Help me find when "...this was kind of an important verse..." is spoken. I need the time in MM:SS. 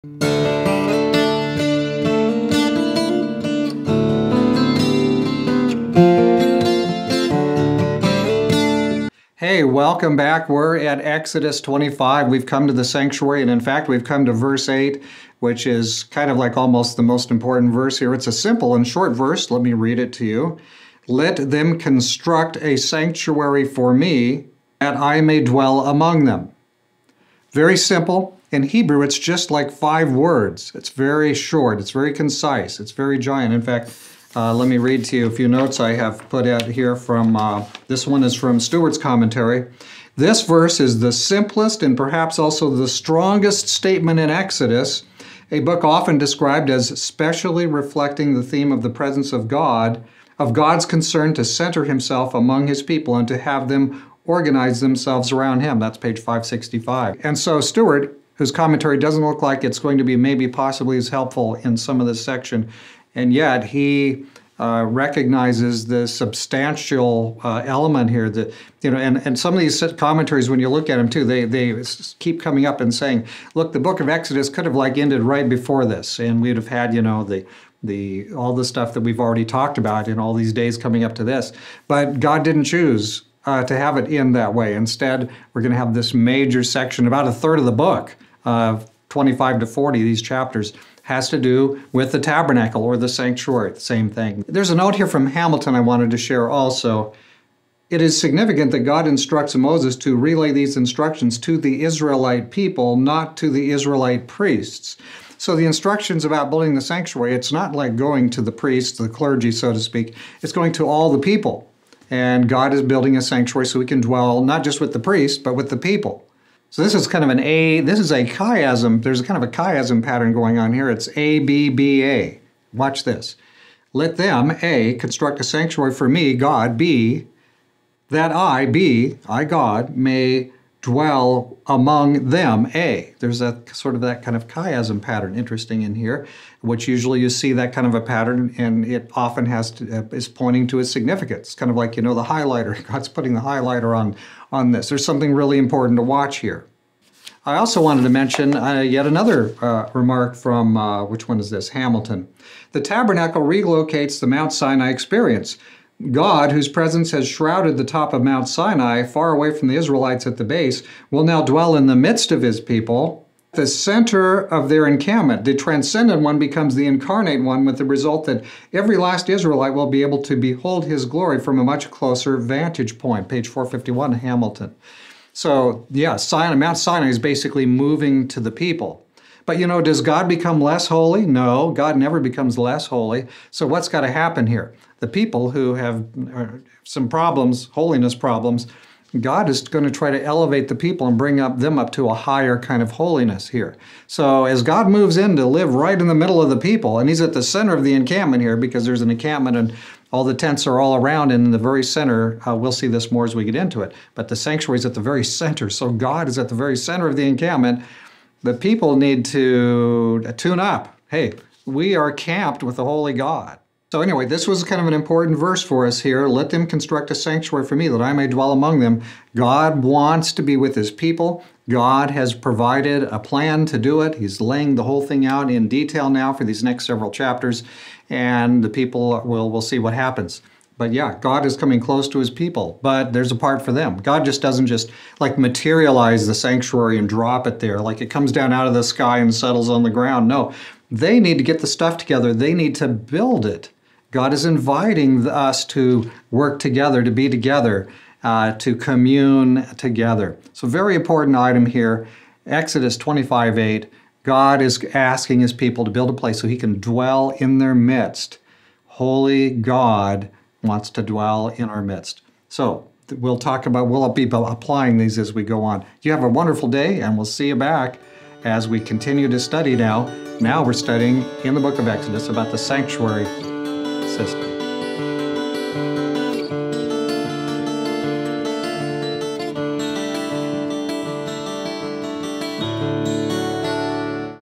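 03:34.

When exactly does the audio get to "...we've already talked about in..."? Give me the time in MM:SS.
01:19.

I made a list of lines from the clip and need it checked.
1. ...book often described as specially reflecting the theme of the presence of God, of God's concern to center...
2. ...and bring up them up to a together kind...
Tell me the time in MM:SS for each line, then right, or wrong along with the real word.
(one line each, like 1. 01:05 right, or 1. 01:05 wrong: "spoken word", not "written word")
1. 00:45 right
2. 03:11 wrong: "higher", not "together".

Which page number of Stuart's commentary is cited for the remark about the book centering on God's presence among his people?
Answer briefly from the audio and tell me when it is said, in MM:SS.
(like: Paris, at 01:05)
565, at 00:56.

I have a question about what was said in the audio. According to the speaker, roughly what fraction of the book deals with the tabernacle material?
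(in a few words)
A third.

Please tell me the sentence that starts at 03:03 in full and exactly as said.
So, what's got to happen here?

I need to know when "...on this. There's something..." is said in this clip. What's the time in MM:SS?
02:24.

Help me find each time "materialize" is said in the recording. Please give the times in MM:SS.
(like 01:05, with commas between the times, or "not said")
03:55.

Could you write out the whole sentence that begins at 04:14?
God is asking his people to build a place so he can dwell in their midst.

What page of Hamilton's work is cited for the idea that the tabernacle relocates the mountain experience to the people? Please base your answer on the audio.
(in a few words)
451.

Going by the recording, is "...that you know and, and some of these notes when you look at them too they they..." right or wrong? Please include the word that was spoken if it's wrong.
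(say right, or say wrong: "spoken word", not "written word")
wrong: "commentaries", not "notes".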